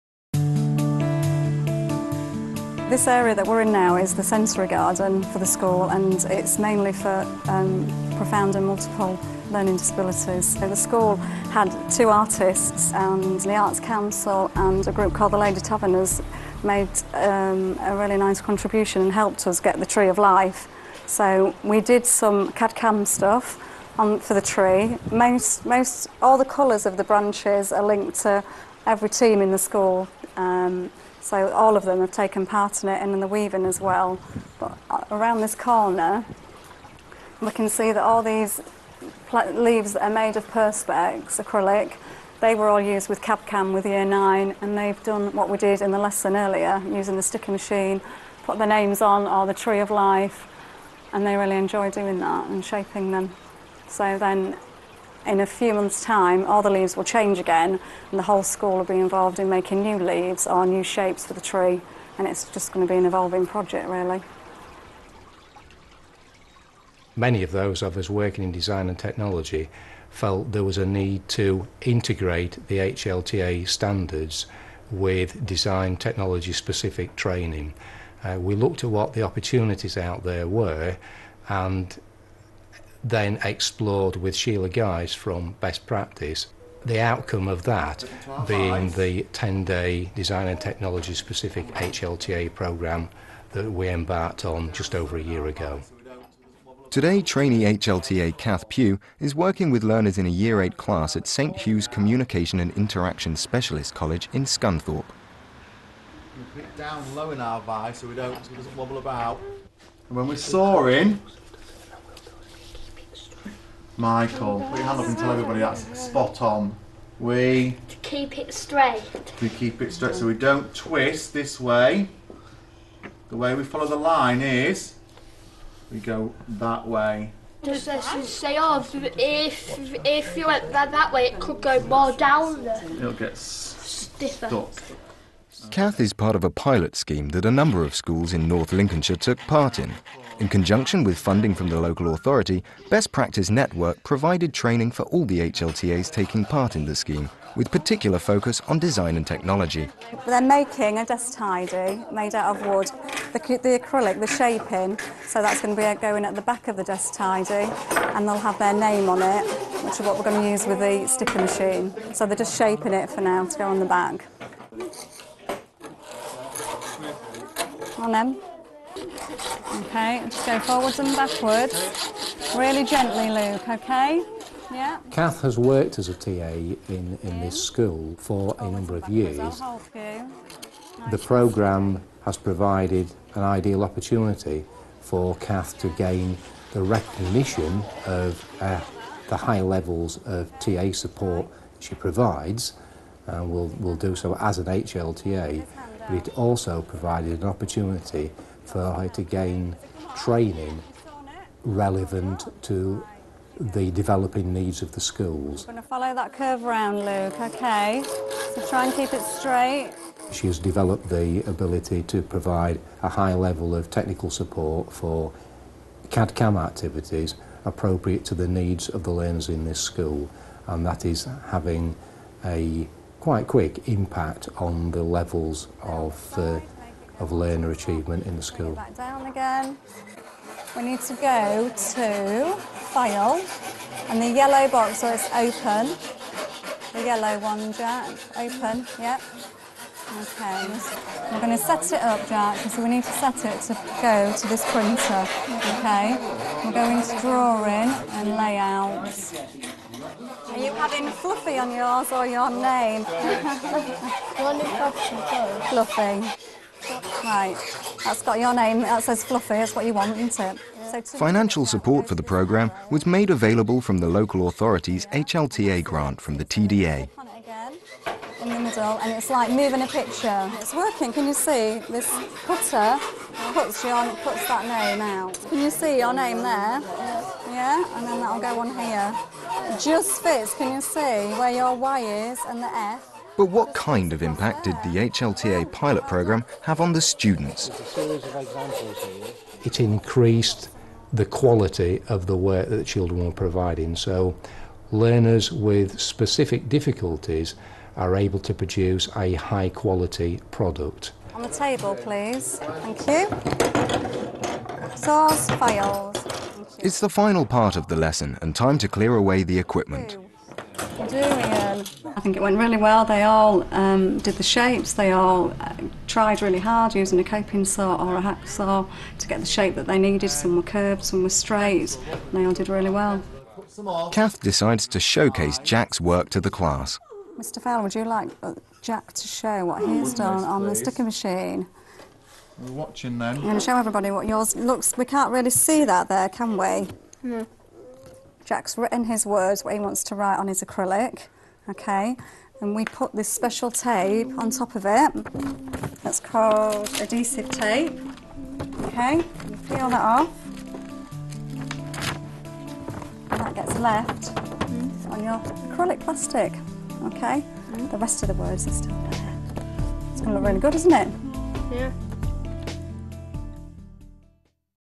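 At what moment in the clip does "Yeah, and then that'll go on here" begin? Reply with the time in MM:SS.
04:37.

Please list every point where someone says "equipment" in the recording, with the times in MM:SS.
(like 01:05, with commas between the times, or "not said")
05:09.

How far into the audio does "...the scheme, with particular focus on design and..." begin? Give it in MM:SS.
02:26.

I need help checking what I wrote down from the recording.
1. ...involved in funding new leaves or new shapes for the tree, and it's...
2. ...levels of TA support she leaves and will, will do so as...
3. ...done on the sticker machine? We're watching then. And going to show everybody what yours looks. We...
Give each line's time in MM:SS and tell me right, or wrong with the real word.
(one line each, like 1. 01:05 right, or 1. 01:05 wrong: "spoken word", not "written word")
1. 00:58 wrong: "making", not "funding"
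2. 03:09 wrong: "provides", not "leaves"
3. 05:30 right.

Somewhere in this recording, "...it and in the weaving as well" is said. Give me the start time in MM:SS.
00:32.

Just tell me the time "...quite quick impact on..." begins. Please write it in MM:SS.
03:43.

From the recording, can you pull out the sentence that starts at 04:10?
Are you having Fluffy on yours or your name?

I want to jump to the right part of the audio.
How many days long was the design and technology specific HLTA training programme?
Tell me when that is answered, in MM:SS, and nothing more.
01:29.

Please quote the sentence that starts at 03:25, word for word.
I'm going to follow that curve around, Luke, okay?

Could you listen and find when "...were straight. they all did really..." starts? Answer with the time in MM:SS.
05:21.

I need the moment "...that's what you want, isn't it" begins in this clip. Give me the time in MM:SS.
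04:19.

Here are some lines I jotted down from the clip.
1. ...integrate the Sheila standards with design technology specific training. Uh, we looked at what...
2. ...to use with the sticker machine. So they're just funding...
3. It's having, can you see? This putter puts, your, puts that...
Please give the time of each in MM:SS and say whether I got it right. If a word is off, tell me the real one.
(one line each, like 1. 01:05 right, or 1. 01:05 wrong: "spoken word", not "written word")
1. 01:11 wrong: "HLTA", not "Sheila"
2. 02:40 wrong: "shaping", not "funding"
3. 04:30 wrong: "working", not "having".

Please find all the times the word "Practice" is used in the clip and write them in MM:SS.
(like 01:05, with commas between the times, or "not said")
01:25, 02:23.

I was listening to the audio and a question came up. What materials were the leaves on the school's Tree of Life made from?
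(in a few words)
Perspex, acrylic.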